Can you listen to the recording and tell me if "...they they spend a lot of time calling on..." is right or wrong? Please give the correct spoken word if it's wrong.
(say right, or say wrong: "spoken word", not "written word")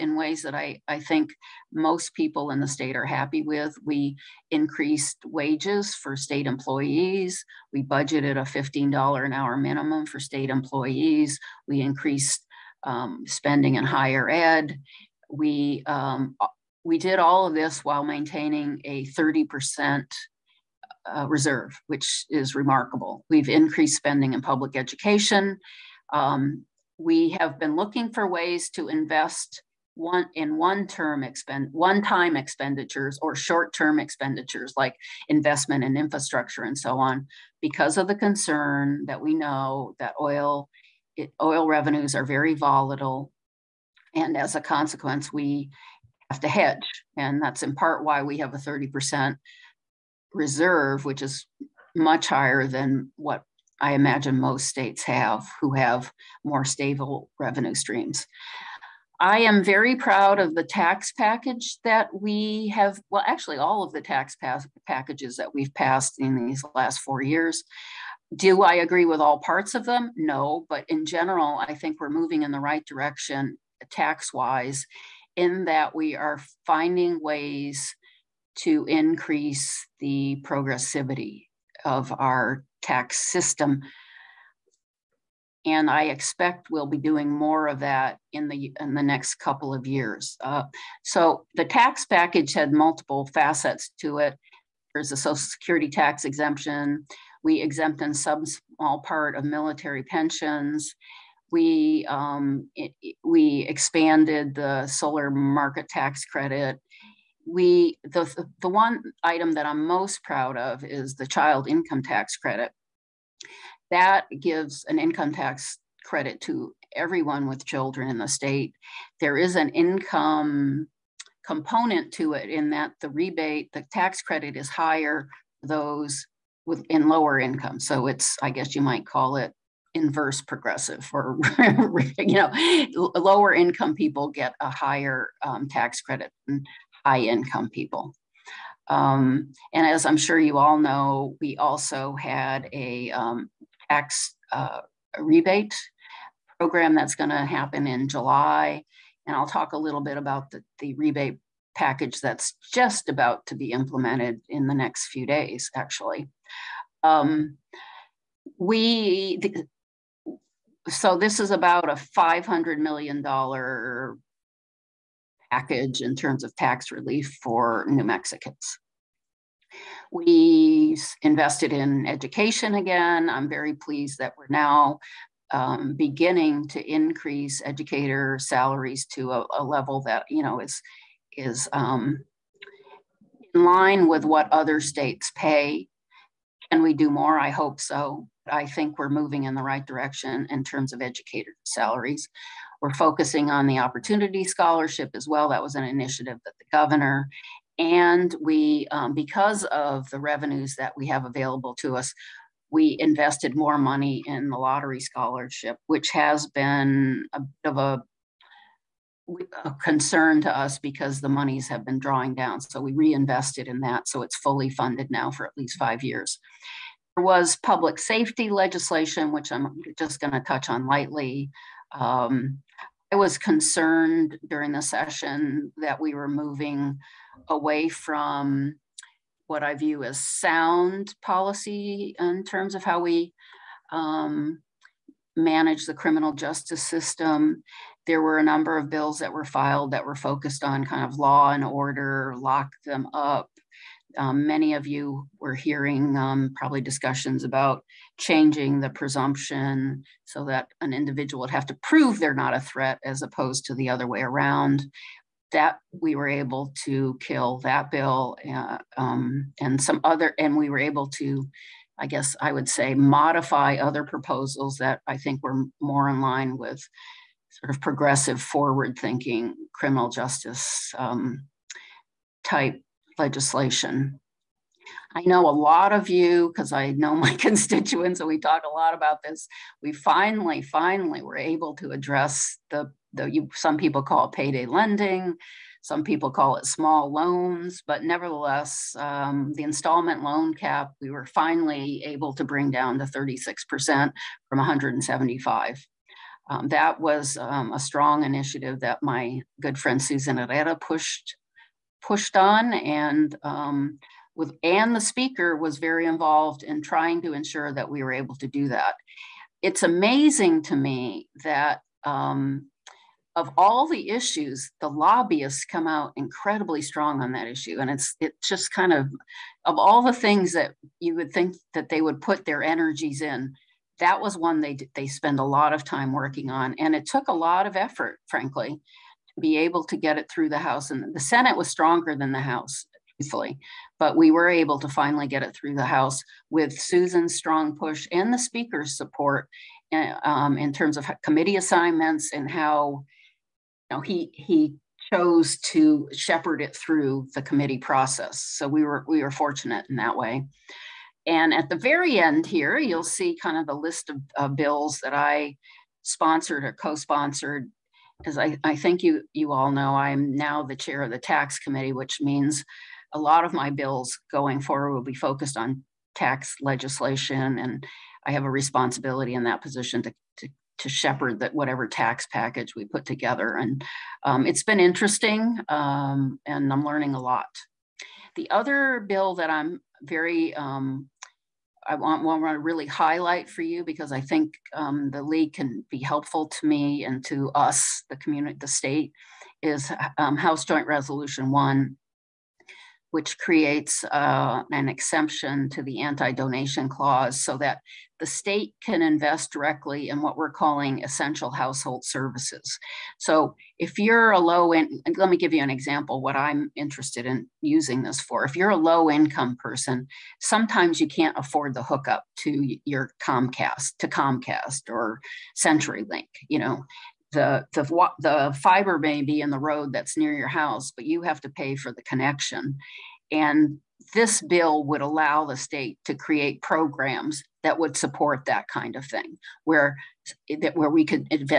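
wrong: "working", not "calling".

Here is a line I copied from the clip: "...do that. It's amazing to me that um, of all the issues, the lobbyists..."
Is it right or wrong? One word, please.
right.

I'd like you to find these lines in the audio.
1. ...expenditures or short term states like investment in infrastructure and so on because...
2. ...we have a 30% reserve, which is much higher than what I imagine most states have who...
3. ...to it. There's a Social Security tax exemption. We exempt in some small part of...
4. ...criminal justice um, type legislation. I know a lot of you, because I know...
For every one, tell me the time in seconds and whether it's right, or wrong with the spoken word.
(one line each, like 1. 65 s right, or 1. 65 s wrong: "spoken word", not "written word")
1. 32 s wrong: "expenditures", not "states"
2. 48 s right
3. 94 s right
4. 269 s right.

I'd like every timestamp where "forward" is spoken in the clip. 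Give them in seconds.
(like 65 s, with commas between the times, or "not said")
268 s, 364 s.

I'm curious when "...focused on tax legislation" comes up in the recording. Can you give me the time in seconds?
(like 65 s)
365 s.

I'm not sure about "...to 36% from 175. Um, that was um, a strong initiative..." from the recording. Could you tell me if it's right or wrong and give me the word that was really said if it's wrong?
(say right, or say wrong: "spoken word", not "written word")
right.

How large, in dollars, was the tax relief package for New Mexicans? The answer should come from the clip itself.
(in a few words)
$500 million.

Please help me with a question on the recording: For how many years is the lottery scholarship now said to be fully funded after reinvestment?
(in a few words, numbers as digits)
5 years.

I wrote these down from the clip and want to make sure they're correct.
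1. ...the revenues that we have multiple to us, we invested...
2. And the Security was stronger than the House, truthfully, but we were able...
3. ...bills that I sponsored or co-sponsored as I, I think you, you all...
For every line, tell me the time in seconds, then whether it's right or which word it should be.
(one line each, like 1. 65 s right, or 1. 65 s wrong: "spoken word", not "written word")
1. 200 s wrong: "available", not "multiple"
2. 330 s wrong: "Senate", not "Security"
3. 354 s right.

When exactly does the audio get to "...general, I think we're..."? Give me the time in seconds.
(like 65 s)
71 s.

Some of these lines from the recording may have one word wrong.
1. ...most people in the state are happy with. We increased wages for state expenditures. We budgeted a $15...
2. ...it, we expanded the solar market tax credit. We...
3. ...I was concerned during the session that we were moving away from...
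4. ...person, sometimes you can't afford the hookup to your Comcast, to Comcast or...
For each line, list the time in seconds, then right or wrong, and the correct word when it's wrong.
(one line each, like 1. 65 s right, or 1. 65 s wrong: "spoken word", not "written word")
1. 1 s wrong: "employees", not "expenditures"
2. 102 s right
3. 223 s right
4. 409 s right.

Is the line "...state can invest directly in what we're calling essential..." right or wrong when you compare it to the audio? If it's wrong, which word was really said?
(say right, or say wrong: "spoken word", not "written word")
right.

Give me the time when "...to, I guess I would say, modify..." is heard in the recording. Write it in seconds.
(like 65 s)
261 s.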